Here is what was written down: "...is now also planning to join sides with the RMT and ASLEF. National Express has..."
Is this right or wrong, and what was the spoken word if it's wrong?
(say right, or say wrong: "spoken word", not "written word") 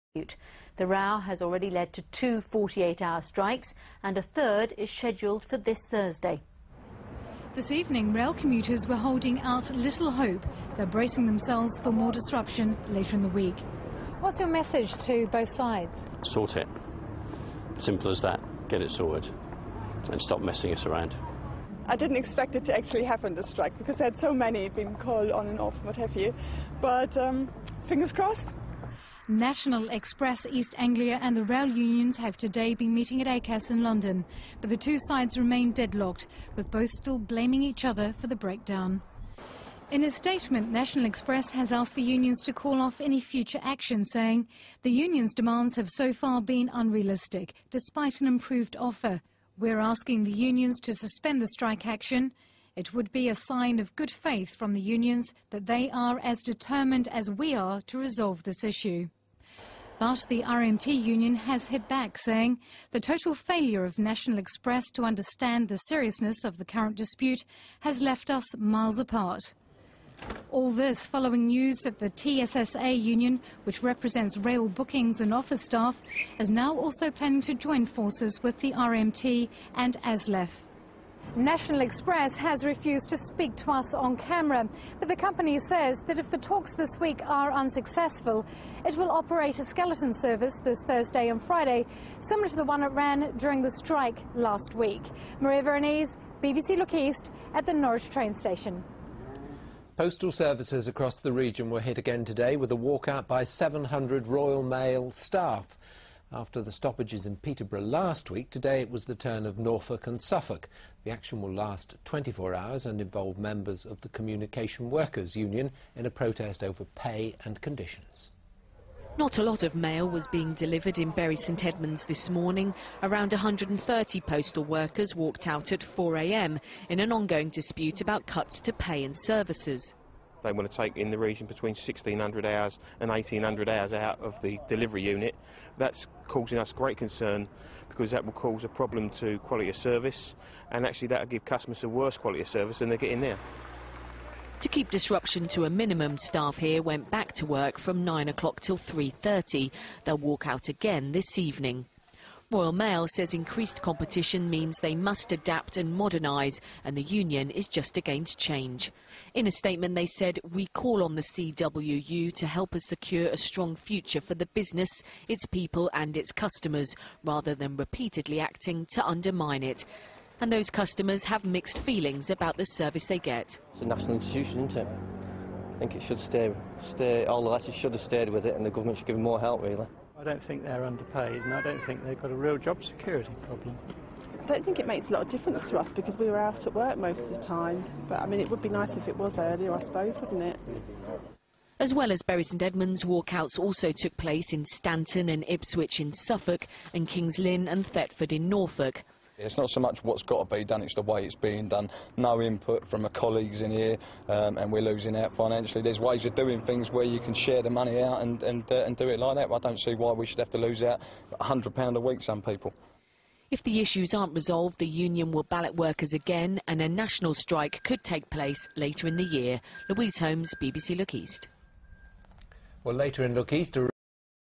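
wrong: "forces", not "sides".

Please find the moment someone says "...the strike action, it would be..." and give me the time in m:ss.
0:51.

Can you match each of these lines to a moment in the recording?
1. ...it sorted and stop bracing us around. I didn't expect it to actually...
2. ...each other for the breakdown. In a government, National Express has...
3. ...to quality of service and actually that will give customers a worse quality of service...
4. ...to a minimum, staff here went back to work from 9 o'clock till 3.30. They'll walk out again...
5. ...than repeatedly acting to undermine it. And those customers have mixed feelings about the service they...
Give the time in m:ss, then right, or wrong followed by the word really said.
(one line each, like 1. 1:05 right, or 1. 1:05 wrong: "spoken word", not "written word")
1. 0:18 wrong: "messing", not "bracing"
2. 0:37 wrong: "statement", not "government"
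3. 2:19 right
4. 2:25 right
5. 2:47 right.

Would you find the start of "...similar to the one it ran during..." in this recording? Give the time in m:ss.
1:32.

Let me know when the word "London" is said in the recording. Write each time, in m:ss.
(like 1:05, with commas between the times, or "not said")
0:33.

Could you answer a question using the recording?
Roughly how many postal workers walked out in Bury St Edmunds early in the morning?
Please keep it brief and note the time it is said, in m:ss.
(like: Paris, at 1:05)
130, at 2:03.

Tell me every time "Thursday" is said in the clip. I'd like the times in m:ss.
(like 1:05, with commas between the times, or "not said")
0:05, 1:30.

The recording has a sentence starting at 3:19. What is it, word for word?
It's not so much what's got to be done, it's the way it's being done.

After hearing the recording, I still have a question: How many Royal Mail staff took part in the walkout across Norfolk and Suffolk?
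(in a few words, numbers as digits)
700.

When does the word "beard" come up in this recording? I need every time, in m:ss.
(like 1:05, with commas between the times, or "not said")
not said.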